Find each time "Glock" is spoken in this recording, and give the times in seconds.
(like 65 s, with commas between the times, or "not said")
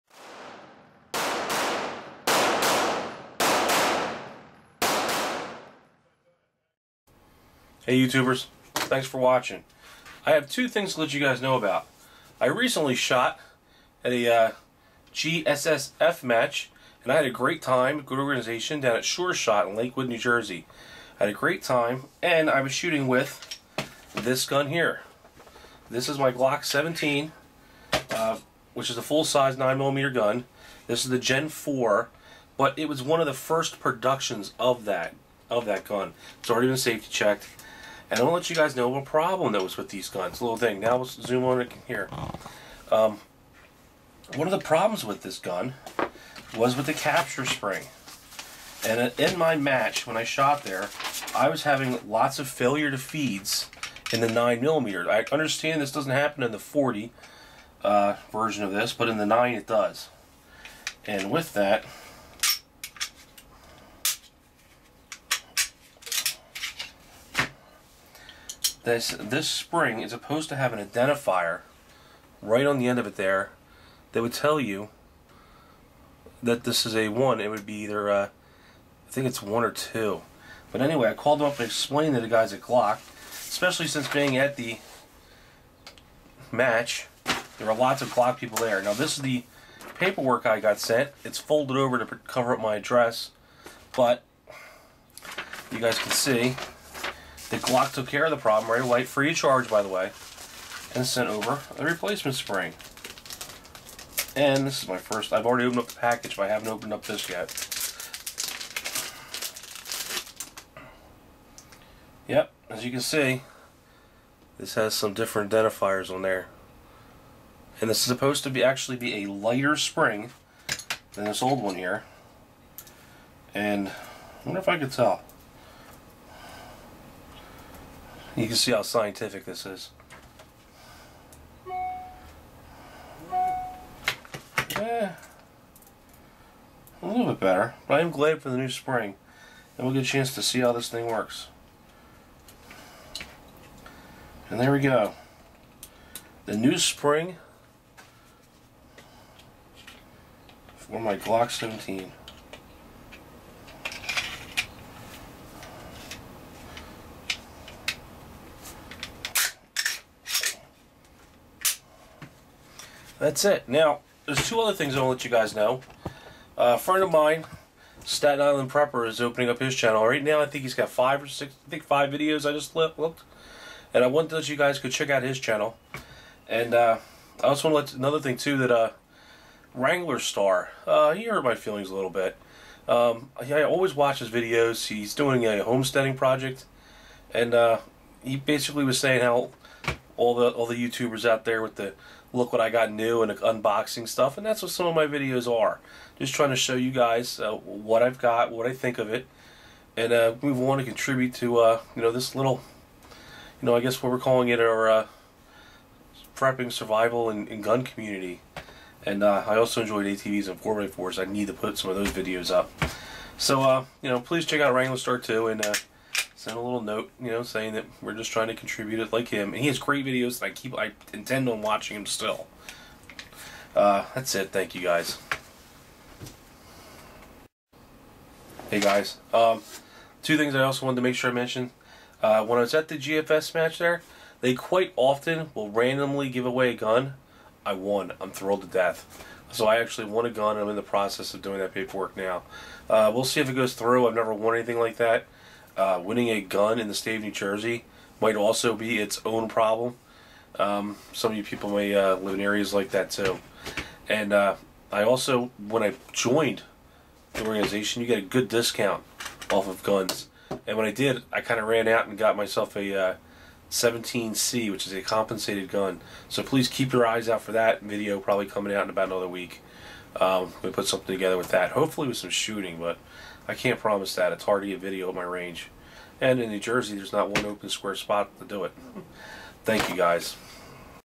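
26 s, 82 s, 88 s, 97 s, 151 s.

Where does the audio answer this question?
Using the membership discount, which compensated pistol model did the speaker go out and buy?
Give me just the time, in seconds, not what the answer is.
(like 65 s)
263 s.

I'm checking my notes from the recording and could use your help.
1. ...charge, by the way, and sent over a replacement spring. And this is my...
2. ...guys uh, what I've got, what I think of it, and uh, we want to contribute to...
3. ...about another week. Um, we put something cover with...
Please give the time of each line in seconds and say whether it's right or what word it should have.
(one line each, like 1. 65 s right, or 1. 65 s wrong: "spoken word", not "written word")
1. 99 s right
2. 196 s right
3. 268 s wrong: "together", not "cover".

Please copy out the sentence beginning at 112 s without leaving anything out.
Yep, as you can see, this has some different identifiers on there.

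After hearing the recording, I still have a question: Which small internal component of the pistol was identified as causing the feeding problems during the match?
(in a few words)
capture spring.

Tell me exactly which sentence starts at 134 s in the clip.
Eh, a little bit better, but I am glad for the new spring.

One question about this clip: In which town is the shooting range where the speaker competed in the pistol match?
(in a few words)
Lakewood, New Jersey.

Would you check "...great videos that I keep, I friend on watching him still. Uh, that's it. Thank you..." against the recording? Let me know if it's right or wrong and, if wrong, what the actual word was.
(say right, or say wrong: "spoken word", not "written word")
wrong: "intend", not "friend".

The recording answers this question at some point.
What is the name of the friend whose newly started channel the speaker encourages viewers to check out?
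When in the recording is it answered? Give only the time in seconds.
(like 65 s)
168 s.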